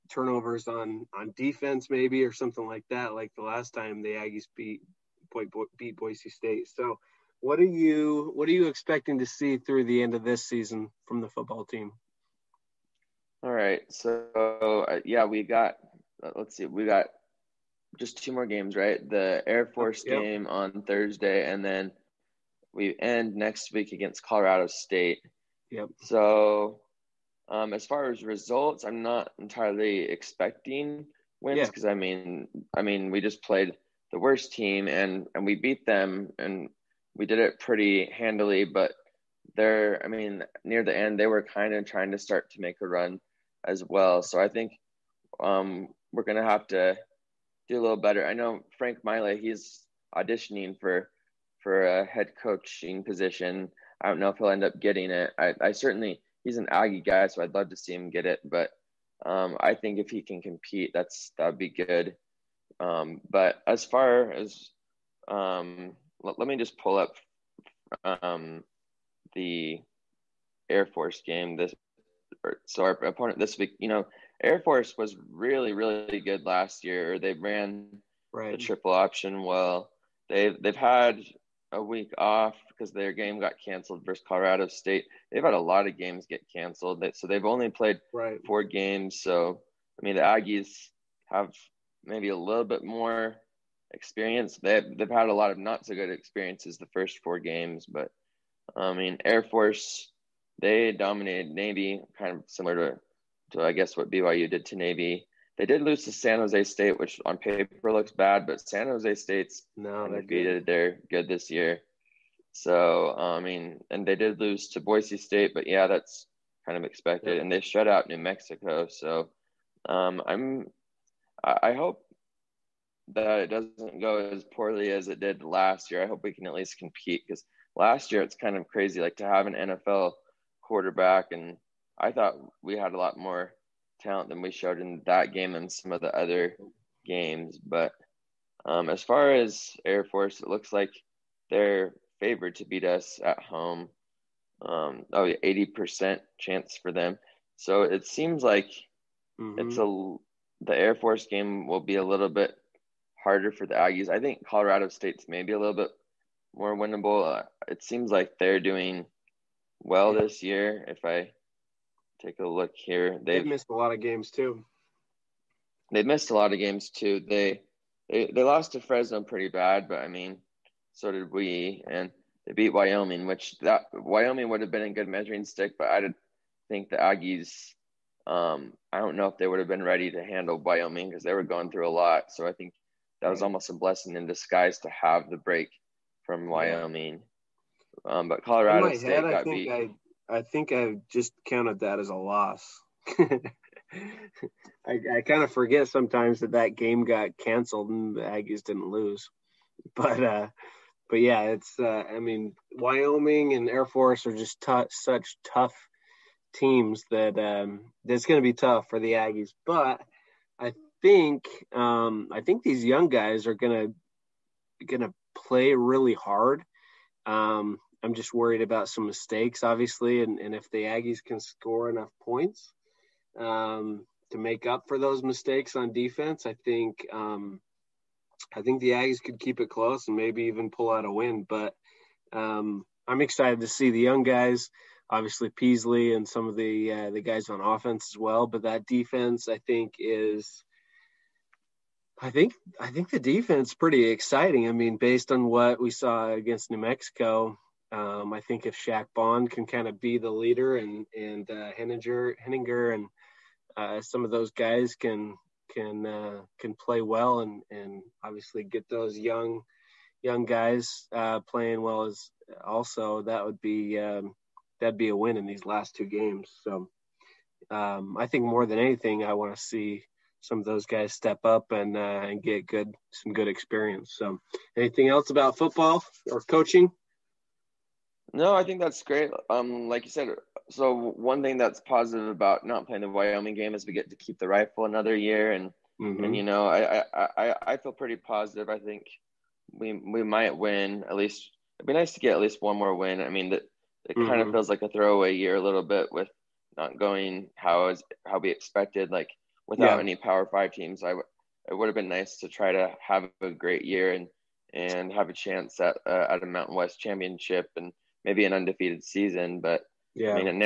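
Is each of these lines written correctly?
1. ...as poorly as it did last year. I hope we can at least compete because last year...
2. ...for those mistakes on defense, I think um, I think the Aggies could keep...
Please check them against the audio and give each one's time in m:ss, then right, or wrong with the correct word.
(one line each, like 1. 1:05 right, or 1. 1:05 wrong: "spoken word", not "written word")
1. 2:04 right
2. 3:44 right.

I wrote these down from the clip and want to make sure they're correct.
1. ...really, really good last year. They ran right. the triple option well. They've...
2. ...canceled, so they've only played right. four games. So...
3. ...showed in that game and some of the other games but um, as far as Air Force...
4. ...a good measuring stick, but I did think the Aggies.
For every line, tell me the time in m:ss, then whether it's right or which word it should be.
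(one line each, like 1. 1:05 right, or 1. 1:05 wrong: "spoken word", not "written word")
1. 1:15 right
2. 1:26 right
3. 2:14 right
4. 2:54 right.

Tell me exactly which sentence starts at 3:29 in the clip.
But I think um, I think these young guys are gonna gonna play really hard.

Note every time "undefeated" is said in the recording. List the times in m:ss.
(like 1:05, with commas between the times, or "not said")
1:50, 5:08.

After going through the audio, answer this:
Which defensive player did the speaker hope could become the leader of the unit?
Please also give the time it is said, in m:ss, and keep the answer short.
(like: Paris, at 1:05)
Shaq Bond, at 4:08.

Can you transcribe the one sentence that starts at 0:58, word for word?
But um, I think if he can compete, that's that'd be good.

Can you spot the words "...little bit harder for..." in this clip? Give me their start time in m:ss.
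2:32.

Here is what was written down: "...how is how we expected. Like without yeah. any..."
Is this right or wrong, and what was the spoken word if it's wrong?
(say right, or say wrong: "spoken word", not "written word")
right.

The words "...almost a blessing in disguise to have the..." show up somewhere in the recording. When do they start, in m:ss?
3:03.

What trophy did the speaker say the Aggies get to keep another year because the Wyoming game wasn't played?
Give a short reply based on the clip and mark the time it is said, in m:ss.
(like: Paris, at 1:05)
the rifle, at 4:44.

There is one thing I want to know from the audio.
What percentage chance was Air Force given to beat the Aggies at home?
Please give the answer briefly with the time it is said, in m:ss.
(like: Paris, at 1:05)
80%, at 2:25.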